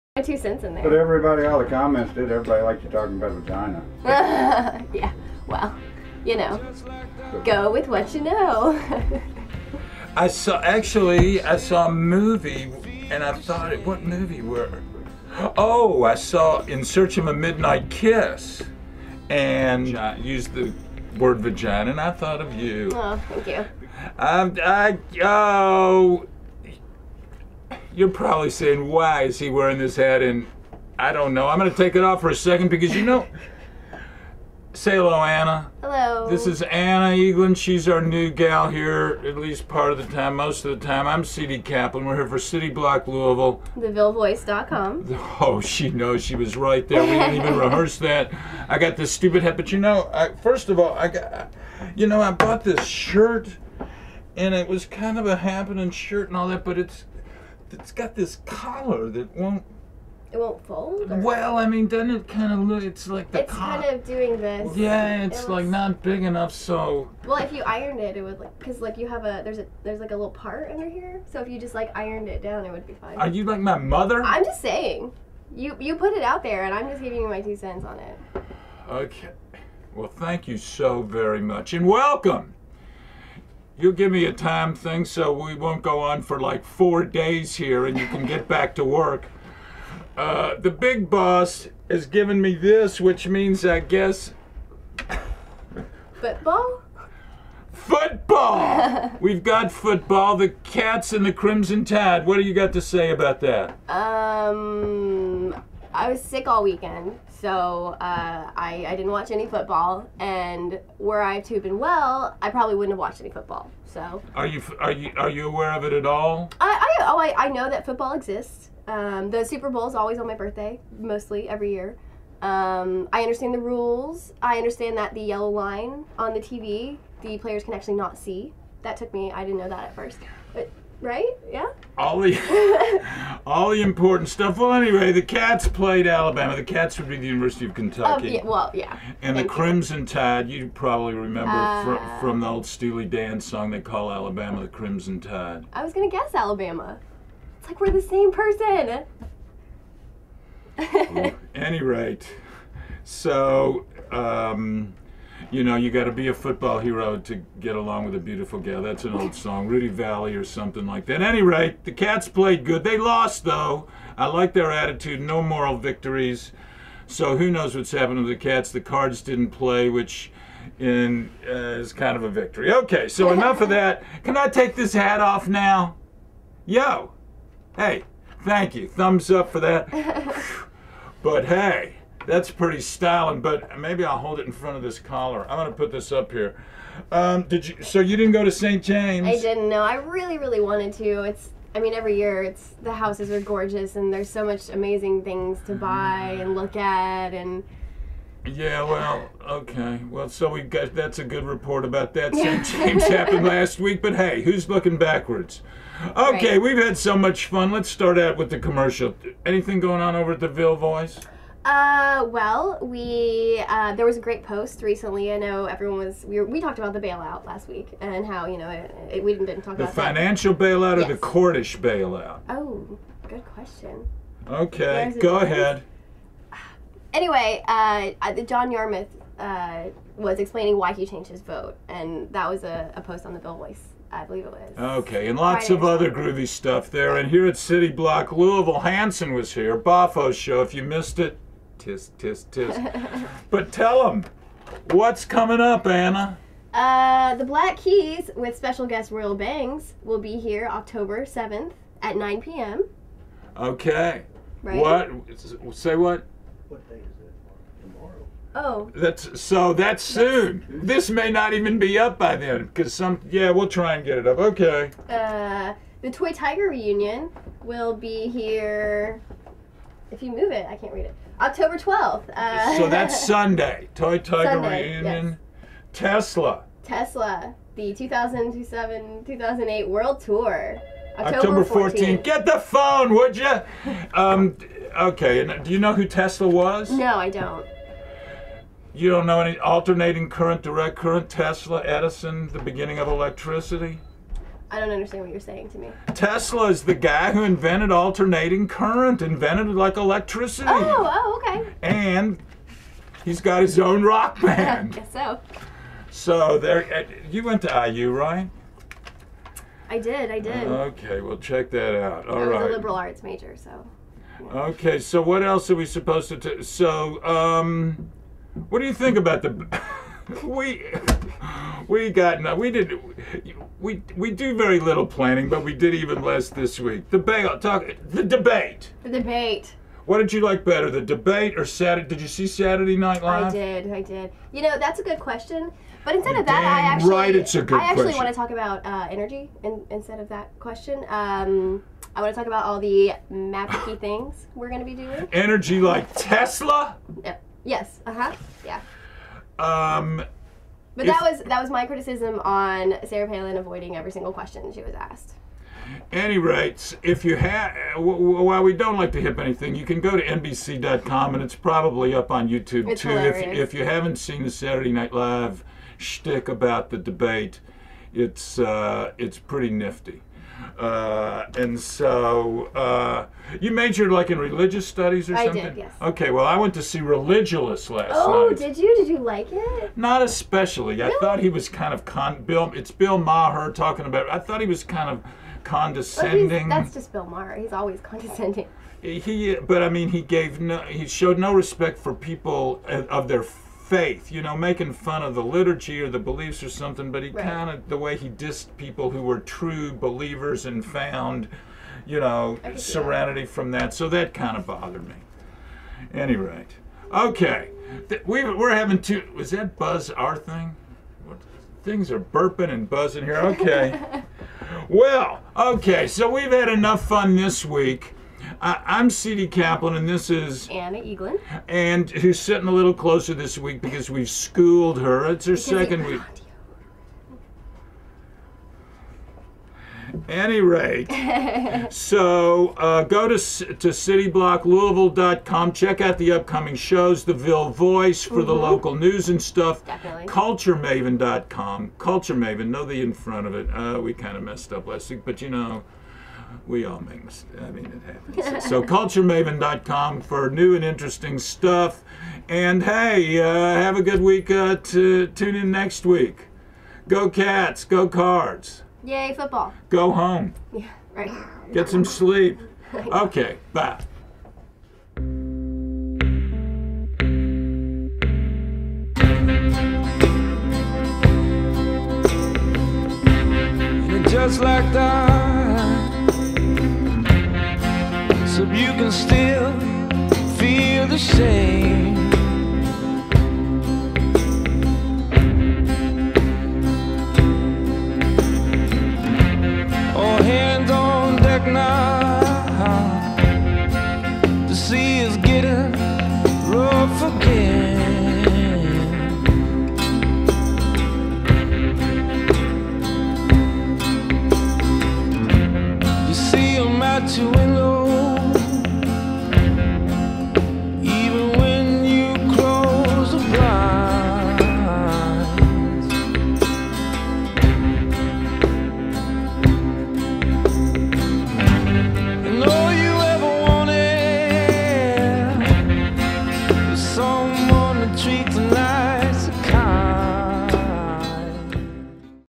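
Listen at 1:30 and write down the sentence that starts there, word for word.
Uh, the big boss has given me this, which means I guess.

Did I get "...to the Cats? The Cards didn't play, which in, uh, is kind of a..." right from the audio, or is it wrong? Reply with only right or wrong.
right.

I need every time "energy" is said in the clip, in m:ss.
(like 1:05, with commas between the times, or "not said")
5:39, 5:45.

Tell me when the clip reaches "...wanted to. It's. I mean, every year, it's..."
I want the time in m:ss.
3:10.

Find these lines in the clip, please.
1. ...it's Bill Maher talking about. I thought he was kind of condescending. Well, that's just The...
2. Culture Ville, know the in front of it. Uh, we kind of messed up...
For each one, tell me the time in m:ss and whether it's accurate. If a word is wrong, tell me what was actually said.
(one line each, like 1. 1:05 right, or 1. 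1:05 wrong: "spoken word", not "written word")
1. 6:22 wrong: "Bill", not "The"
2. 7:21 wrong: "Maven", not "Ville".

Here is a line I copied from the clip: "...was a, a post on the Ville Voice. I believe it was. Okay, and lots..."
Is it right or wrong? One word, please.
right.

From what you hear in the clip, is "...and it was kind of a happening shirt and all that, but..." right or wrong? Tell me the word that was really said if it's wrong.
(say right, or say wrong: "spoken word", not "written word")
right.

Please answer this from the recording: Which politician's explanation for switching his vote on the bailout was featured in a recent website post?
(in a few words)
John Yarmuth.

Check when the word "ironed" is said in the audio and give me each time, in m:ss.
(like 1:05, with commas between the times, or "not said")
1:07, 1:11.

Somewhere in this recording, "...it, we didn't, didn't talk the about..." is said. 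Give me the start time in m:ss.
3:39.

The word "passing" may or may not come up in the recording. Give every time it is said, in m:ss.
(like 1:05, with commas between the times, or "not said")
not said.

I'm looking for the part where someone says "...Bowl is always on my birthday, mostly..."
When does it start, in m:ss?
1:59.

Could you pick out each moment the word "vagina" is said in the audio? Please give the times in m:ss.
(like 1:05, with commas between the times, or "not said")
0:03, 0:21.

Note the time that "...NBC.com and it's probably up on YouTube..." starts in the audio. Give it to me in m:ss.
6:00.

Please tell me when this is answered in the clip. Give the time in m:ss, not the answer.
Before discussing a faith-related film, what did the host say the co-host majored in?
6:14.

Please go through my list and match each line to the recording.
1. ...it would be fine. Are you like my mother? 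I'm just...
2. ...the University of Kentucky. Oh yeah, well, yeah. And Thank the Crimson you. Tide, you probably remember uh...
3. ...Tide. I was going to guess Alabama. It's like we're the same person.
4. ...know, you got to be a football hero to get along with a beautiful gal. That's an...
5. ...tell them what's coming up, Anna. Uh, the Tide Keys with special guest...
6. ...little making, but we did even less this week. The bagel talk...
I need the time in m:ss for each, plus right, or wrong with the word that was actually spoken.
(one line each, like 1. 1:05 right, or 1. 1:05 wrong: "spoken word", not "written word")
1. 1:12 right
2. 2:17 right
3. 2:25 right
4. 2:35 right
5. 4:03 wrong: "Black", not "Tide"
6. 5:24 wrong: "planning", not "making".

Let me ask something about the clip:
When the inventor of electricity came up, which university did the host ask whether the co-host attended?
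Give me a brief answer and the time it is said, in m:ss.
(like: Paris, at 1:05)
IU, at 5:07.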